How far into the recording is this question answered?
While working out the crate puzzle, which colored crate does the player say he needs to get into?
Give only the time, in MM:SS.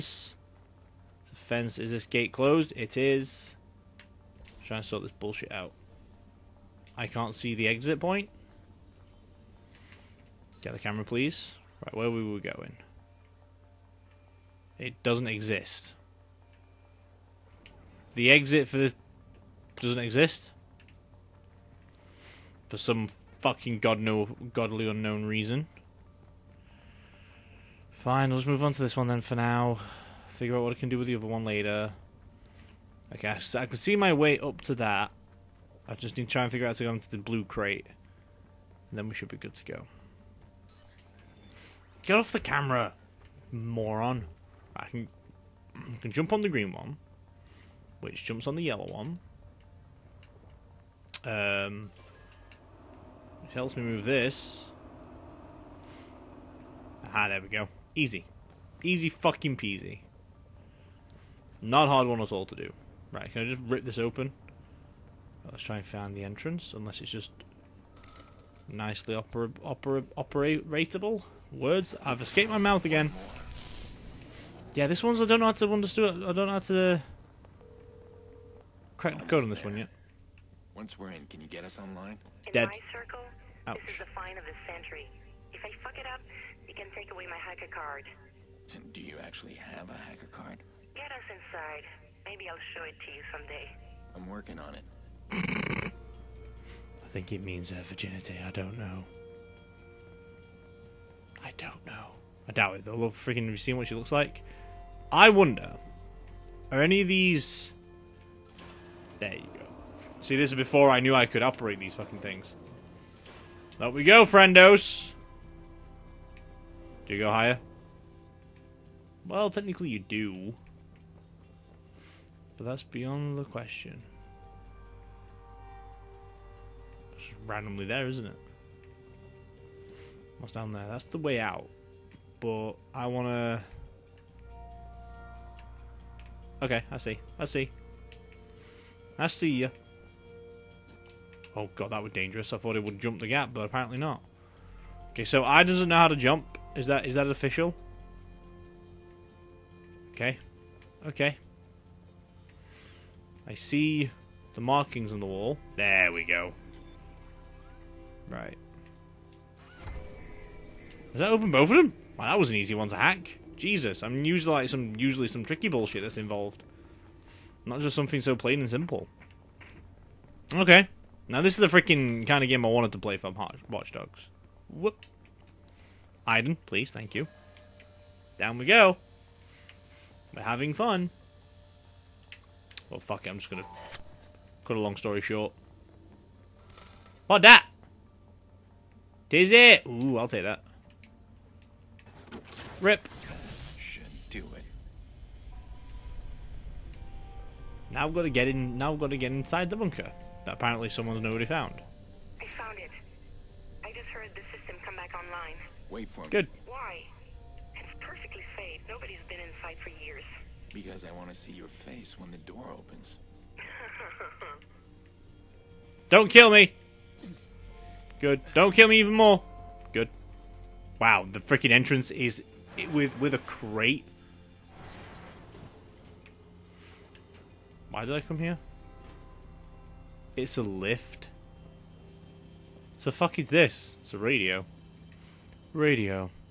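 00:37.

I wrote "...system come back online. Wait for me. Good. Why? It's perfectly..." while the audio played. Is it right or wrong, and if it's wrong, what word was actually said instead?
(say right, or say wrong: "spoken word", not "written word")
right.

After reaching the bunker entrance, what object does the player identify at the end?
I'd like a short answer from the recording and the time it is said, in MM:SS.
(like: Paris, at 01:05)
A radio, at 03:54.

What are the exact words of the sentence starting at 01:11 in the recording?
Words have escaped my mouth again.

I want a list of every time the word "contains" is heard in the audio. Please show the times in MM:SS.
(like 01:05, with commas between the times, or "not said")
not said.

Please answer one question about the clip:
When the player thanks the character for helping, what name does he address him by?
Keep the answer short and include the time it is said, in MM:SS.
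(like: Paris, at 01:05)
Aiden, at 02:56.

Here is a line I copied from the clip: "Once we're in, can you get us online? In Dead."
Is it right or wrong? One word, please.
right.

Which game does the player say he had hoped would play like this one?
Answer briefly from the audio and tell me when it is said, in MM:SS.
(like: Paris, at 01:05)
Watch Dogs, at 02:53.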